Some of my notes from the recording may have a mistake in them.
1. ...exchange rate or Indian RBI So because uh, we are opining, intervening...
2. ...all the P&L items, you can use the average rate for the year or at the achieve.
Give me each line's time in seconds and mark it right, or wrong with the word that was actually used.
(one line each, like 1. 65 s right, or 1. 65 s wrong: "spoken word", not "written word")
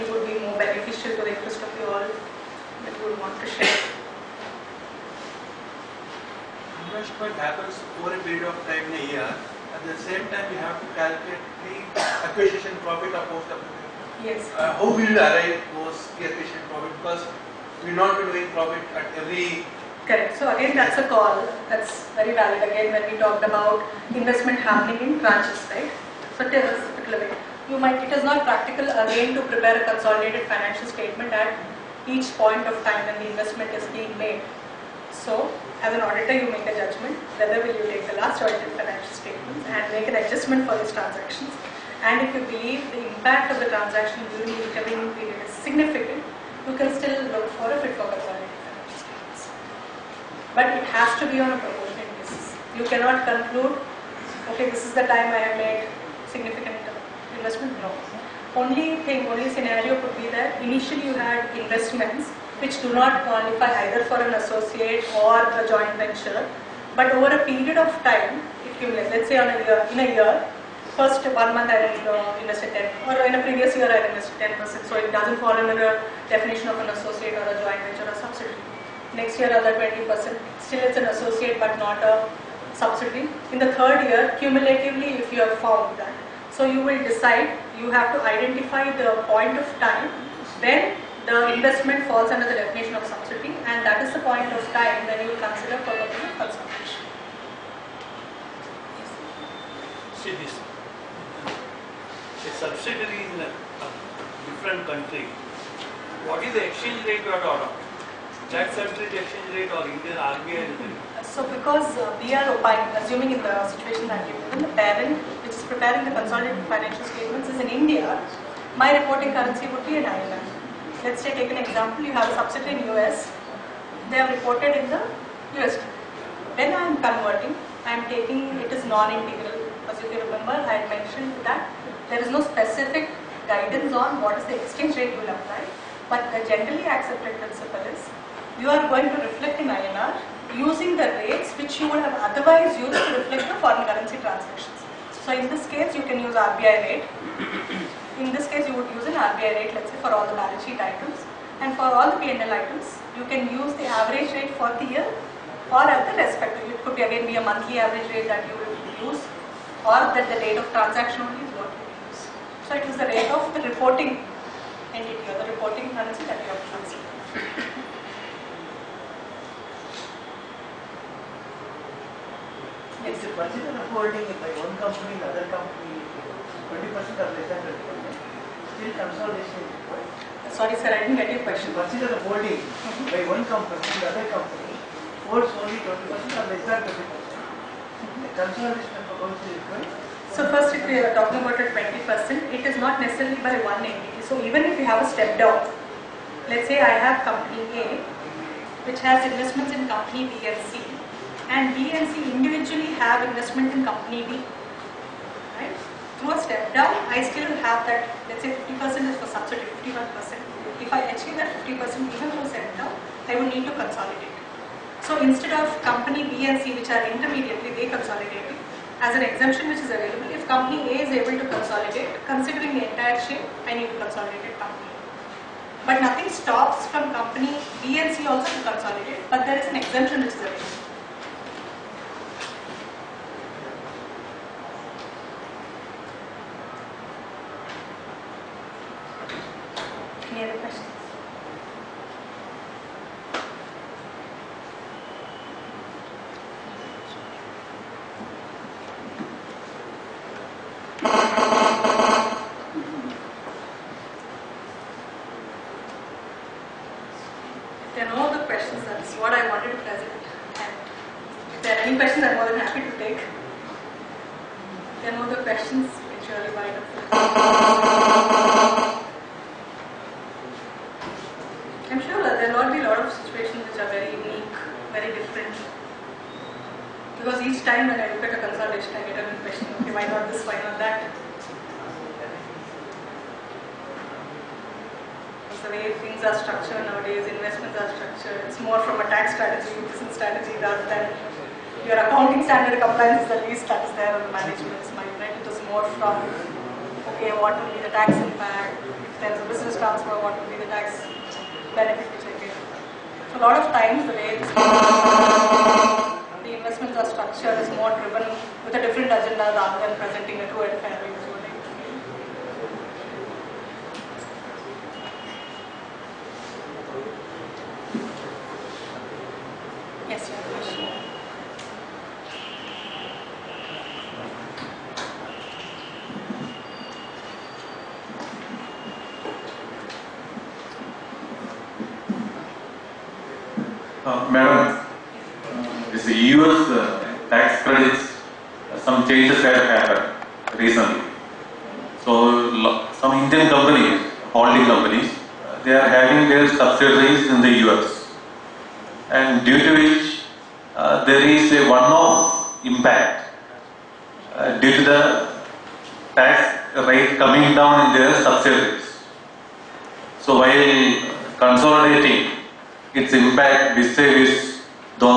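1. 108 s wrong: "assuming", not "intervening"
2. 151 s wrong: "respective", not "achieve".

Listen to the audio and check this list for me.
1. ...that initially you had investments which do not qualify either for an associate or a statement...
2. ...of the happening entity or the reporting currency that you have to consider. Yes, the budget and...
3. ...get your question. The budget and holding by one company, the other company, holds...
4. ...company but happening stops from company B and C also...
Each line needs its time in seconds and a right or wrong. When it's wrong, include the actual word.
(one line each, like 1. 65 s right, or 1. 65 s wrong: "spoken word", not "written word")
1. 60 s wrong: "joint", not "statement"
2. 163 s wrong: "reporting", not "happening"
3. 181 s right
4. 224 s wrong: "nothing", not "happening".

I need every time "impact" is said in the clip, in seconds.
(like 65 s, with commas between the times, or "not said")
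43 s, 363 s.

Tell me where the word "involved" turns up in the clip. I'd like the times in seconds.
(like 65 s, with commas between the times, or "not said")
not said.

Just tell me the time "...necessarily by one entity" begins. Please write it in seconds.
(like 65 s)
193 s.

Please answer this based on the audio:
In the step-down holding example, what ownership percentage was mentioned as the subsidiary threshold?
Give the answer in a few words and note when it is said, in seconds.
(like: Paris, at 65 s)
51%, at 209 s.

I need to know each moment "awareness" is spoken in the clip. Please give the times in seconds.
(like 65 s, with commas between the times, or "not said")
not said.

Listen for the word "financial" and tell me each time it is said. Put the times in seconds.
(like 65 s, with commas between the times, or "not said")
30 s, 38 s, 116 s.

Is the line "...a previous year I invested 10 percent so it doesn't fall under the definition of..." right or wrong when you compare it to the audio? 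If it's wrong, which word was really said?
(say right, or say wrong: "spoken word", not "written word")
right.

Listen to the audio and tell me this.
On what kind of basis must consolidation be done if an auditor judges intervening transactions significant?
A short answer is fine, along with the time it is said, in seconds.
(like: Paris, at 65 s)
Proportionate basis, at 51 s.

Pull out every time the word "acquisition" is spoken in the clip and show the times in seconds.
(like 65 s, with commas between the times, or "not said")
12 s, 16 s.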